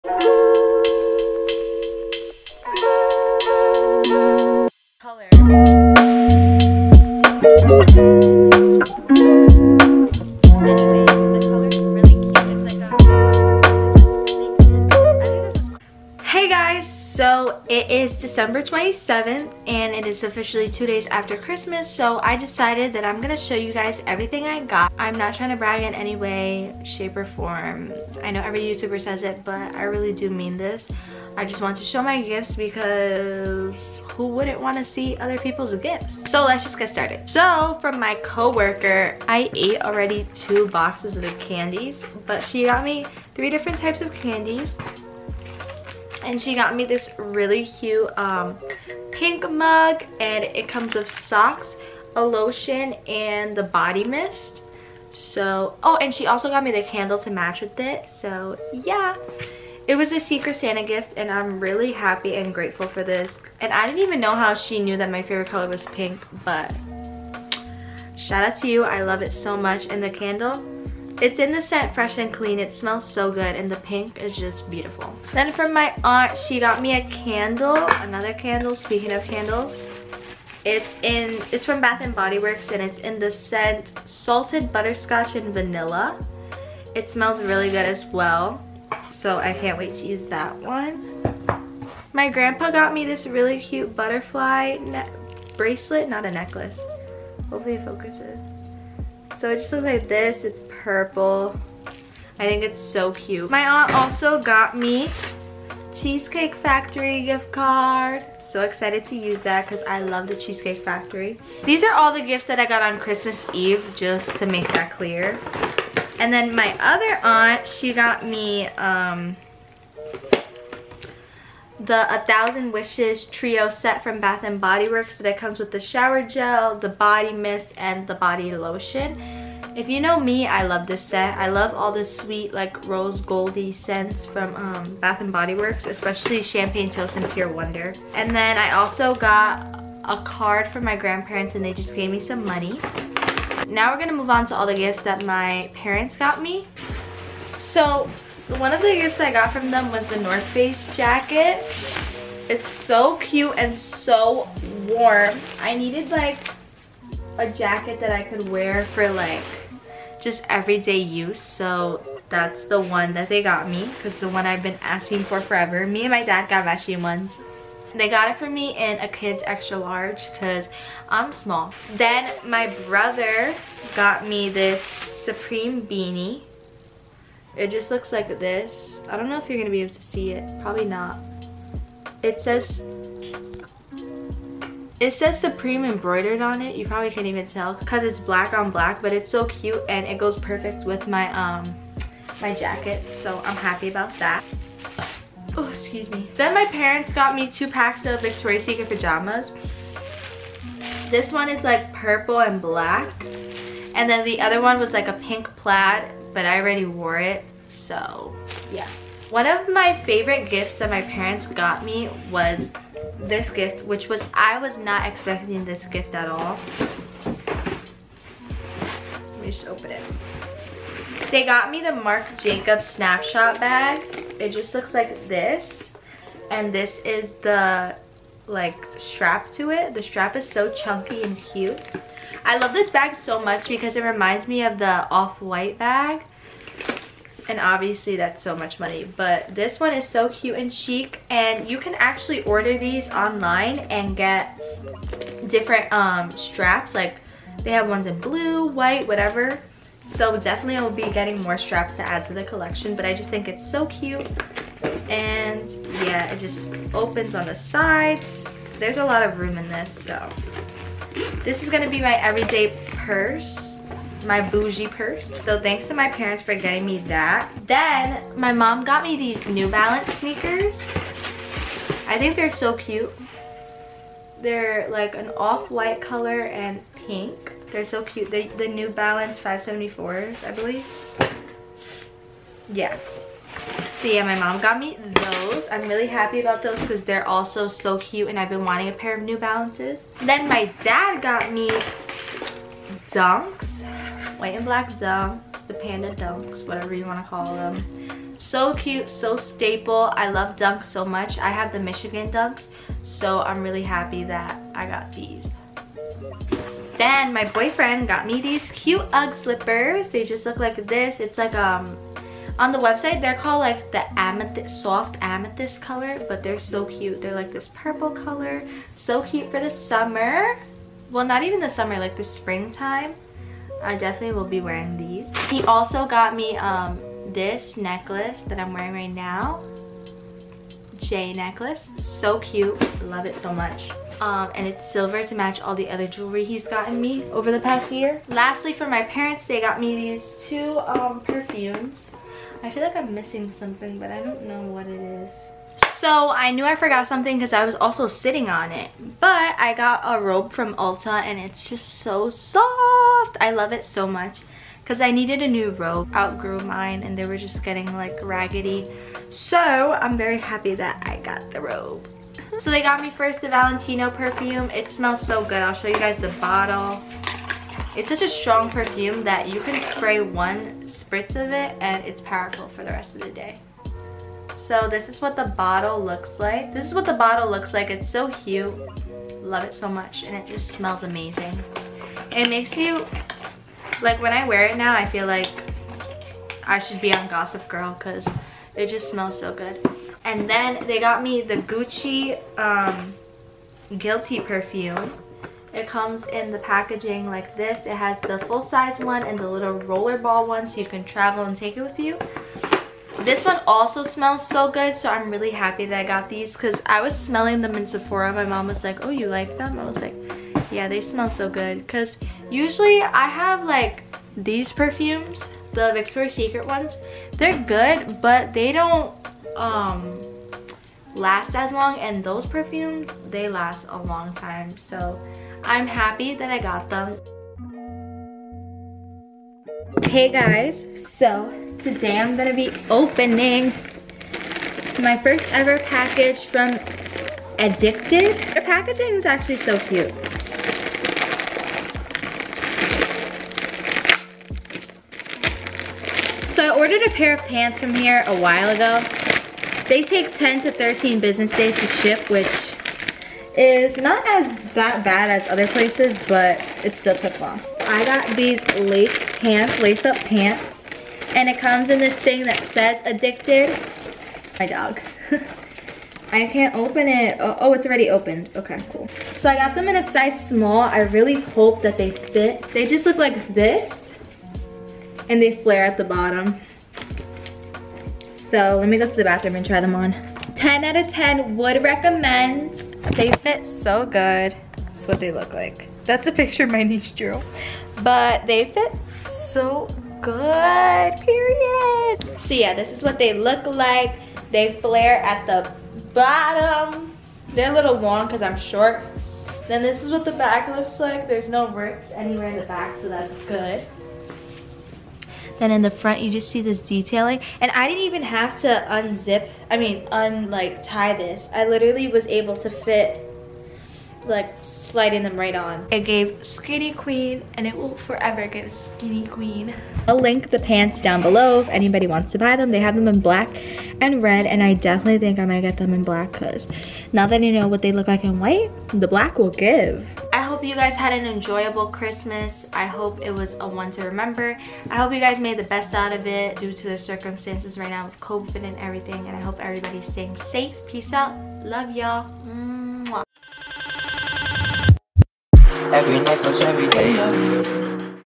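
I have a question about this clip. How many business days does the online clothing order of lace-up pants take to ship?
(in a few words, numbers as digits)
10 to 13.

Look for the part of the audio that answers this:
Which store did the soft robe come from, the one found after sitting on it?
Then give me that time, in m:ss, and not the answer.
5:50.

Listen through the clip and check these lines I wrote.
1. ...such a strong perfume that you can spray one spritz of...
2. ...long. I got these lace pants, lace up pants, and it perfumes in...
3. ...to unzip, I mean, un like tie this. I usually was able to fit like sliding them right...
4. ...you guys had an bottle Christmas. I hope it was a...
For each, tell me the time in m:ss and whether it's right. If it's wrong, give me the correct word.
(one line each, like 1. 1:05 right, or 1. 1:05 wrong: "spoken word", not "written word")
1. 6:08 right
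2. 7:37 wrong: "comes", not "perfumes"
3. 8:28 wrong: "literally", not "usually"
4. 8:50 wrong: "enjoyable", not "bottle".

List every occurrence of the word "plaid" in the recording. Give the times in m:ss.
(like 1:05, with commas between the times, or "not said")
3:25.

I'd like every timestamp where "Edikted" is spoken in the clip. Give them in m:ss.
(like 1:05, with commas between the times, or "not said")
7:17, 7:43.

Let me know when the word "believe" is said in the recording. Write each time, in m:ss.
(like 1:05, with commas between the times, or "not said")
4:40.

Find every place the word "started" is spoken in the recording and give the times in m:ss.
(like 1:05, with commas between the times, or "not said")
0:36.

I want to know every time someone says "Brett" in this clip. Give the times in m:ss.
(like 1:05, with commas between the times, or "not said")
not said.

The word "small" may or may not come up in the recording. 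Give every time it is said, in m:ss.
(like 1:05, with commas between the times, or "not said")
2:51, 7:50.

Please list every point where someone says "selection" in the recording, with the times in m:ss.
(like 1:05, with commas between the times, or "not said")
not said.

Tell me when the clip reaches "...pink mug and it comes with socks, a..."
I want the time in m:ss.
0:49.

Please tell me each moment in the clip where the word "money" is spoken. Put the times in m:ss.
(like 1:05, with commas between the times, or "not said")
2:22, 3:58.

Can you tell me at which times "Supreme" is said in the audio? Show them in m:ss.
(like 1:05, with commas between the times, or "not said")
2:54, 3:05.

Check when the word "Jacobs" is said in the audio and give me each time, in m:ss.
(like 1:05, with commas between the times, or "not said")
3:42.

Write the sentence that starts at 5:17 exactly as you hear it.
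They're like this purple color, so cute for the summer.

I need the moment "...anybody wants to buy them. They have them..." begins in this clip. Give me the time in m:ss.
8:41.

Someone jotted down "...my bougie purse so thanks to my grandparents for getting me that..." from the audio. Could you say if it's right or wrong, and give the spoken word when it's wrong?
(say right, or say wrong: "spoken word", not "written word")
wrong: "parents", not "grandparents".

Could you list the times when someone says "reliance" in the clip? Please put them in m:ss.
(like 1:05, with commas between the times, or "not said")
not said.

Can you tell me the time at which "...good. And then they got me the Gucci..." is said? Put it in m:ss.
6:29.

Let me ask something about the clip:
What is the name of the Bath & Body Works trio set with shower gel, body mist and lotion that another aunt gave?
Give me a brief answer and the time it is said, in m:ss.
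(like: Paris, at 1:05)
A Thousand Wishes, at 2:02.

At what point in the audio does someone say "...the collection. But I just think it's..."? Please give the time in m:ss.
4:12.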